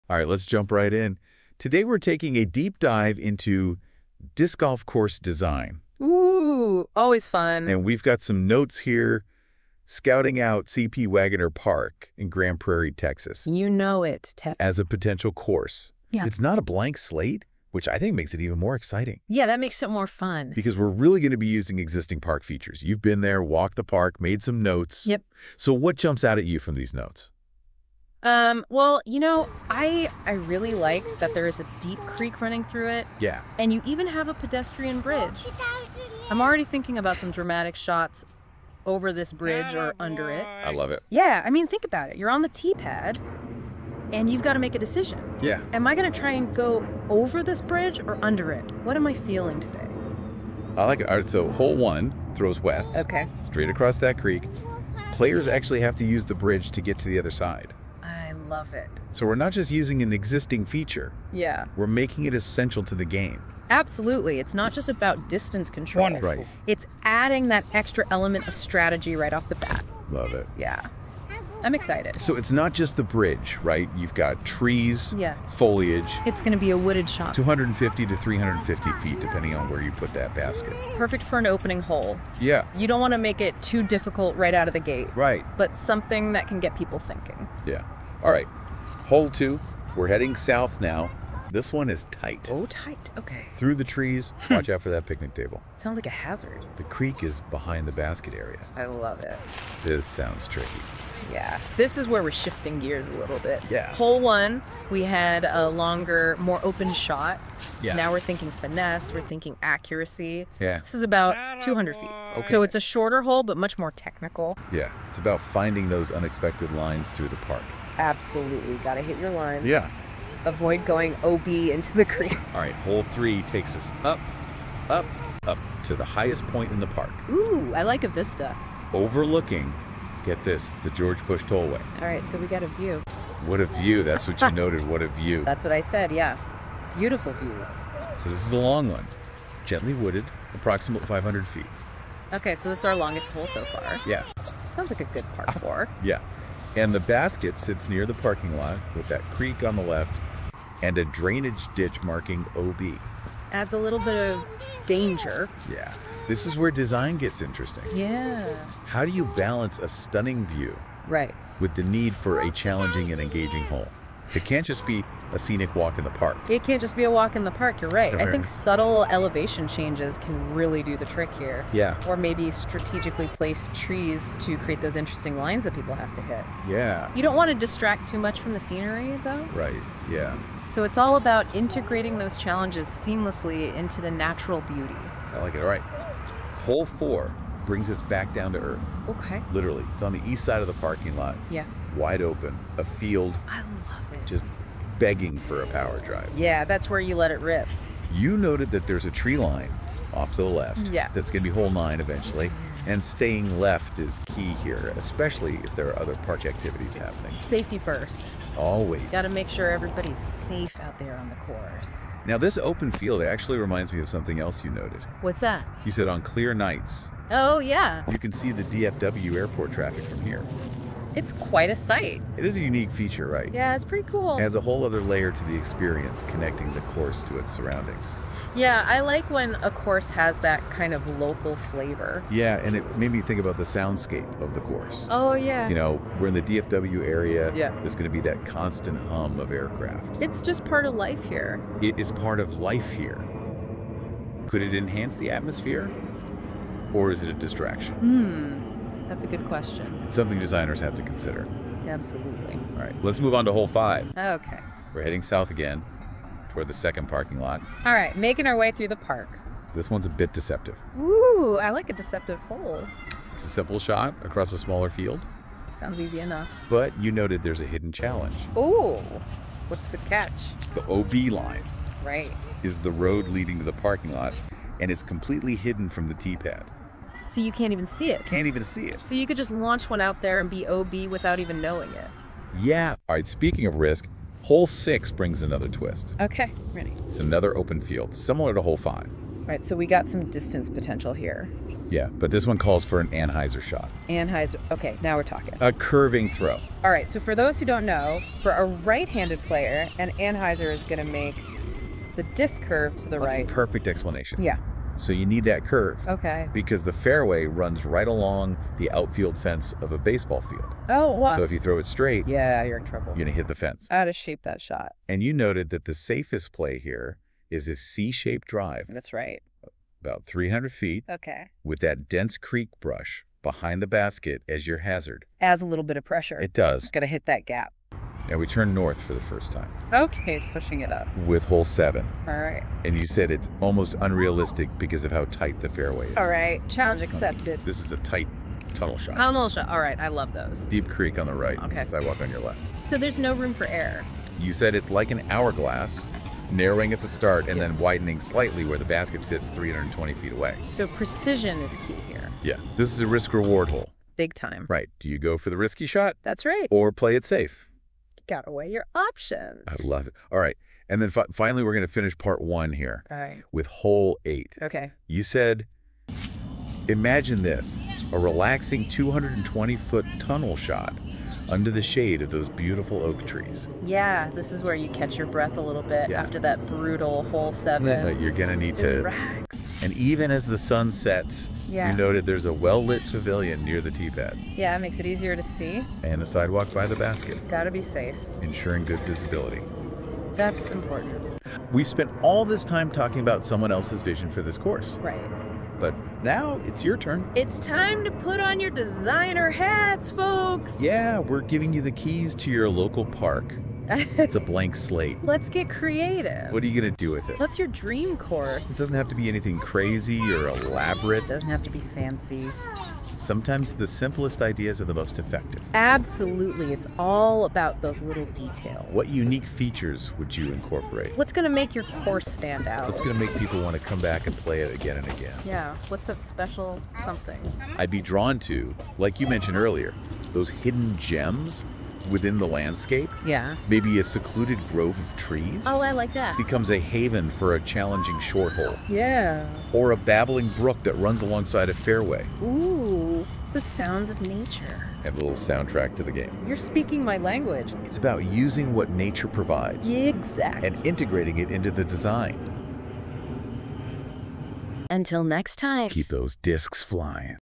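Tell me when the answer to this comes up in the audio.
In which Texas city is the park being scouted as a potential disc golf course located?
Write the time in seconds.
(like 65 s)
12 s.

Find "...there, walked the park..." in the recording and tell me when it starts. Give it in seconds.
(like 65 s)
23 s.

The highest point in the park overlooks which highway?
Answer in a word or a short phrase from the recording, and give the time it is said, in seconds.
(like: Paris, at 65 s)
George Bush Tollway, at 130 s.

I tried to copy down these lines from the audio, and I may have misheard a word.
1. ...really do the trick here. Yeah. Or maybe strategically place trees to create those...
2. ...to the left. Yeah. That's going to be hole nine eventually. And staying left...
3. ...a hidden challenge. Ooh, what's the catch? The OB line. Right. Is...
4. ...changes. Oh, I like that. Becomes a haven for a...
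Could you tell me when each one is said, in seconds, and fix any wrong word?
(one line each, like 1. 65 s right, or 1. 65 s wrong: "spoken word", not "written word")
1. 170 s right
2. 200 s right
3. 267 s right
4. 435 s wrong: "trees", not "changes".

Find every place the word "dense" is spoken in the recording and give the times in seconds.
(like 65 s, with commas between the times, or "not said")
322 s.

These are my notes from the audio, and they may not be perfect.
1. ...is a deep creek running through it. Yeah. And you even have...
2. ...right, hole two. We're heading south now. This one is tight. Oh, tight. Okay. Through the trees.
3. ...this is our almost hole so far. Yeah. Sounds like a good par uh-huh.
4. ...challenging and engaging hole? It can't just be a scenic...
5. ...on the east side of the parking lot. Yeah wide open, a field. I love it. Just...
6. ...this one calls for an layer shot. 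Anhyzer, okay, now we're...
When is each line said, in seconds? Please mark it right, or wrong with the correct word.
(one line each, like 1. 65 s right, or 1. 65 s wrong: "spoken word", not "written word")
1. 31 s right
2. 88 s right
3. 142 s wrong: "longest", not "almost"
4. 162 s right
5. 190 s right
6. 292 s wrong: "anhyzer", not "layer".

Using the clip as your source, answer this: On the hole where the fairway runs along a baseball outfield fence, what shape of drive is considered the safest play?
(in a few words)
C-shaped.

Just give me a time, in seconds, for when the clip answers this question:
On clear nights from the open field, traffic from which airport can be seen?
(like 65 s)
218 s.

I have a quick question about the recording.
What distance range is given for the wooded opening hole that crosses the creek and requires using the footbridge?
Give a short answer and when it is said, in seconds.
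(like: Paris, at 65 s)
250 to 350 feet, at 77 s.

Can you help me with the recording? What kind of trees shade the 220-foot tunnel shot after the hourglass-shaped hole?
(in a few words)
Oak trees.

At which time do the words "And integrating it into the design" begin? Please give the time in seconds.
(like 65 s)
450 s.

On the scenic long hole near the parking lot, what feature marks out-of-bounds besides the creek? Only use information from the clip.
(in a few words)
A drainage ditch.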